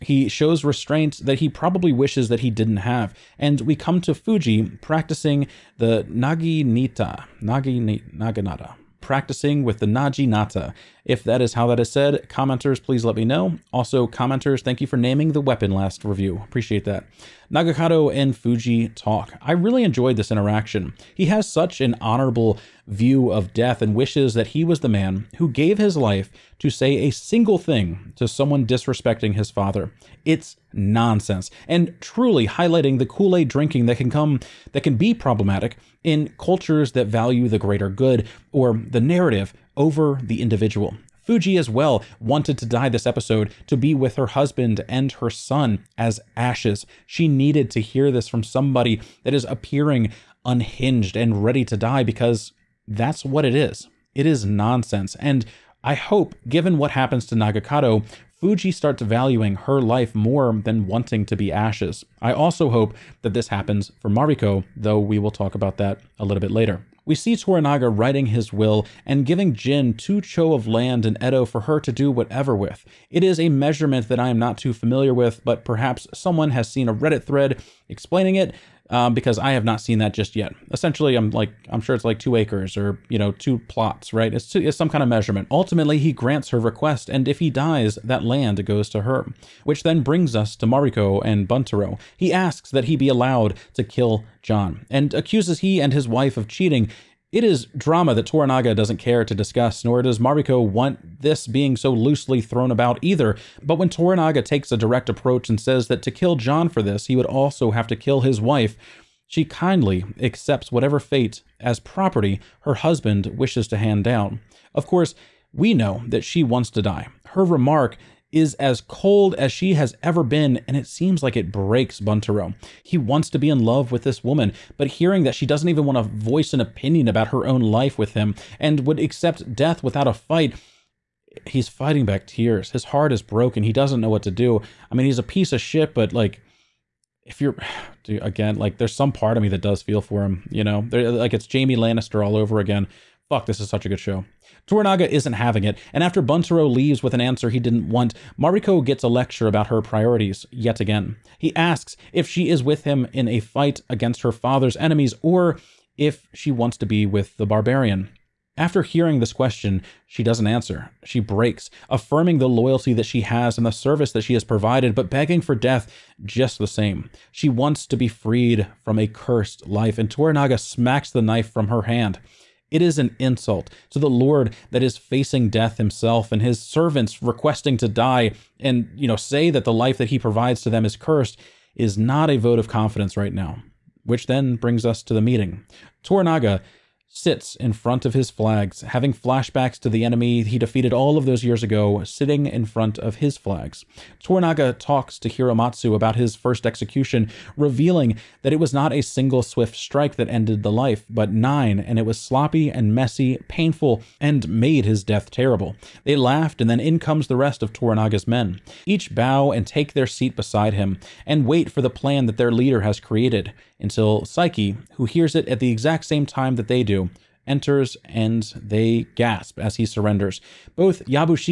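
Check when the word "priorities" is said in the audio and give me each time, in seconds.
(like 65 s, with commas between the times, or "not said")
149 s.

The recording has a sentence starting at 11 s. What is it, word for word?
If that is how that is said, commenters, please let me know.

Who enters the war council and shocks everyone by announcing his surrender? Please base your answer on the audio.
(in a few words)
Saeki.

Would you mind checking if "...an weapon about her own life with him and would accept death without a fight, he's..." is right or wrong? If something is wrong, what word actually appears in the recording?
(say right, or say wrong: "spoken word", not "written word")
wrong: "opinion", not "weapon".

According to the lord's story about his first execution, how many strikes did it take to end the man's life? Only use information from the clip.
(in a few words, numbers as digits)
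9.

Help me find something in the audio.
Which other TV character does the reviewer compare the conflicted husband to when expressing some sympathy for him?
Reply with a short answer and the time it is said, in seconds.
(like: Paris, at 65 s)
Jamie Lannister, at 141 s.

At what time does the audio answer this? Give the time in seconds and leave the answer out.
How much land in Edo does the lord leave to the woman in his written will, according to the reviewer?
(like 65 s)
69 s.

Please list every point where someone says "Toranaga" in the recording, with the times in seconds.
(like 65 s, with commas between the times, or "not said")
67 s, 98 s, 103 s, 144 s, 170 s, 186 s, 194 s, 207 s.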